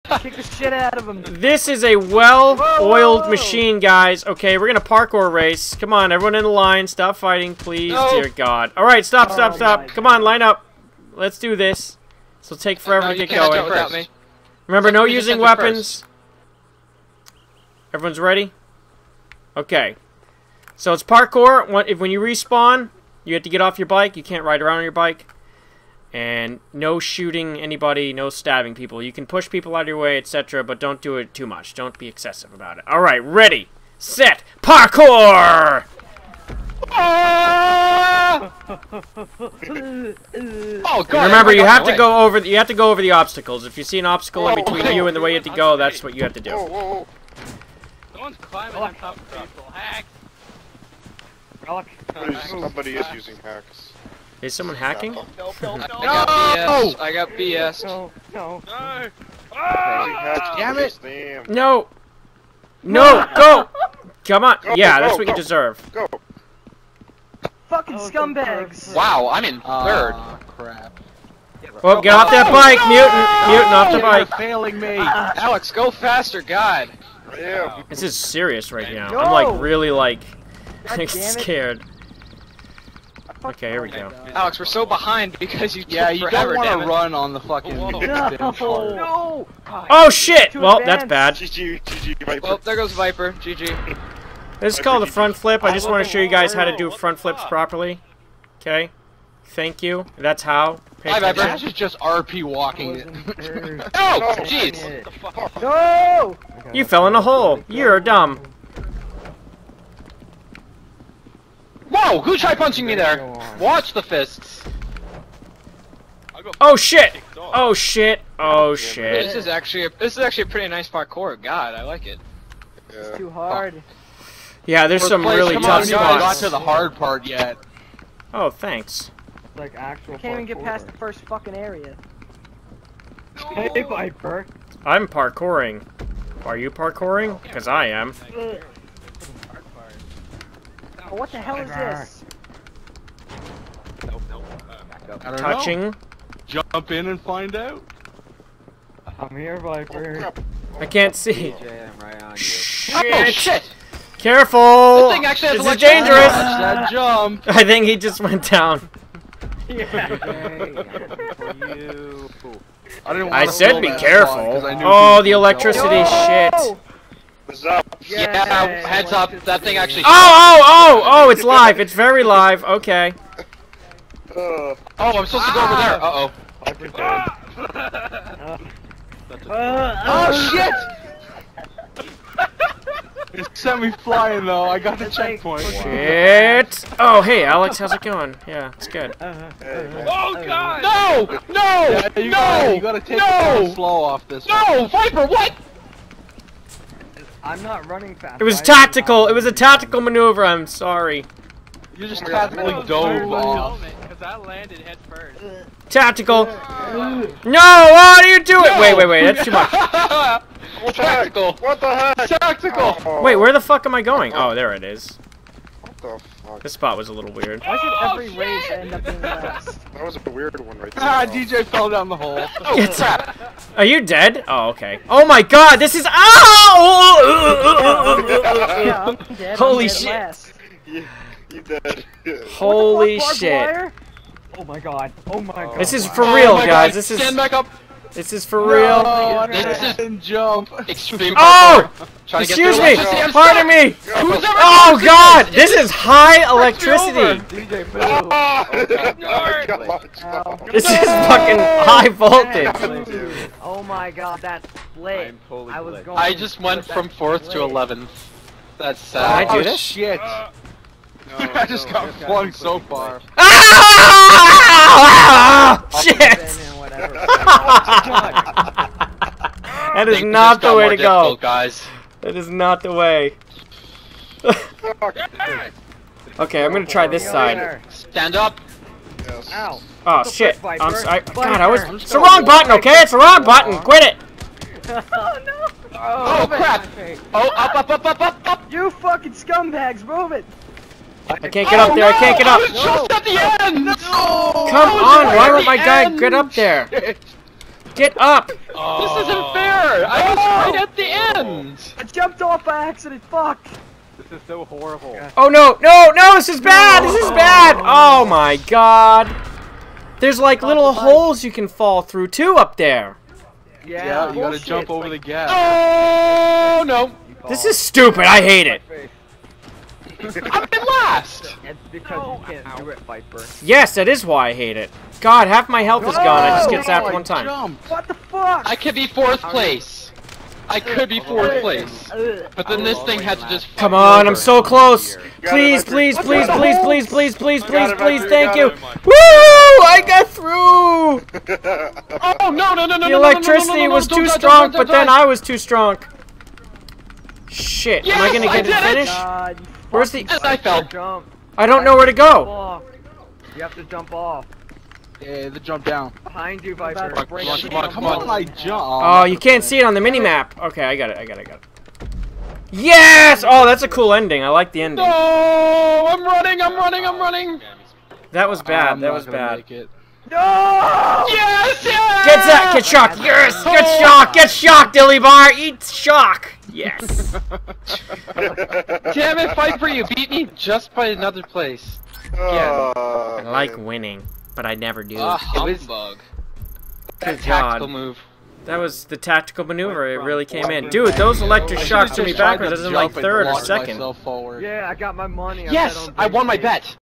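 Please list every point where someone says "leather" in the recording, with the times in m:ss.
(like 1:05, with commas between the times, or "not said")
not said.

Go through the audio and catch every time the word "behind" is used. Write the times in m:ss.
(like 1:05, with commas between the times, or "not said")
1:24, 5:56.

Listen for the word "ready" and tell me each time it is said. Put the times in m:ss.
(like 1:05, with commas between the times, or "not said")
0:18, 0:33.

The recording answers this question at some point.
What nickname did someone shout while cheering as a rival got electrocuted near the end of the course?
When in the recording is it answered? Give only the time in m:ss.
6:14.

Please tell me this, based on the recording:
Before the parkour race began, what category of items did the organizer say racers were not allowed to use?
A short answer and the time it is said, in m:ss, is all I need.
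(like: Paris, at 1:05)
weapons, at 0:15.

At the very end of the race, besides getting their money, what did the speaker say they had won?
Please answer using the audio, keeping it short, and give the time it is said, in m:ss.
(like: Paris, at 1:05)
my bet, at 6:36.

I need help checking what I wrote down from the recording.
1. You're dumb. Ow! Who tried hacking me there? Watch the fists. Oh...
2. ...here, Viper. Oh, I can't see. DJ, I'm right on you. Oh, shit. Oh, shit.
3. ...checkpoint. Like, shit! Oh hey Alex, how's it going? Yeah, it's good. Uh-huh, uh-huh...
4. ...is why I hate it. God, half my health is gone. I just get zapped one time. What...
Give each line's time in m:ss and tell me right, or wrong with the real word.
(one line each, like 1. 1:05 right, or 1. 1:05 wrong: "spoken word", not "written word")
1. 1:47 wrong: "punching", not "hacking"
2. 2:29 right
3. 3:05 right
4. 5:24 right.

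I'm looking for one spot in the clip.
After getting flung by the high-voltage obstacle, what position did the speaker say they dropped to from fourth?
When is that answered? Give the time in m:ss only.
4:17.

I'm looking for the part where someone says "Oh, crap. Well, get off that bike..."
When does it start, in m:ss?
1:10.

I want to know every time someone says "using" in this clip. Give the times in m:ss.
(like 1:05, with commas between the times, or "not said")
0:15, 0:53.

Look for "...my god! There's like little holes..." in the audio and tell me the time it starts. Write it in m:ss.
5:08.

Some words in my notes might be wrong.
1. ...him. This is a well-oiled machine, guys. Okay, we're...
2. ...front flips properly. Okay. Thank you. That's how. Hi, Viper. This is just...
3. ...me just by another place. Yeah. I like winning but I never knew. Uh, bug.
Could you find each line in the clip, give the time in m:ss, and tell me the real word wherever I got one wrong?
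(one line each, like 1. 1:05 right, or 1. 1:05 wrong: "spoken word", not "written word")
1. 0:01 right
2. 1:36 right
3. 6:20 right.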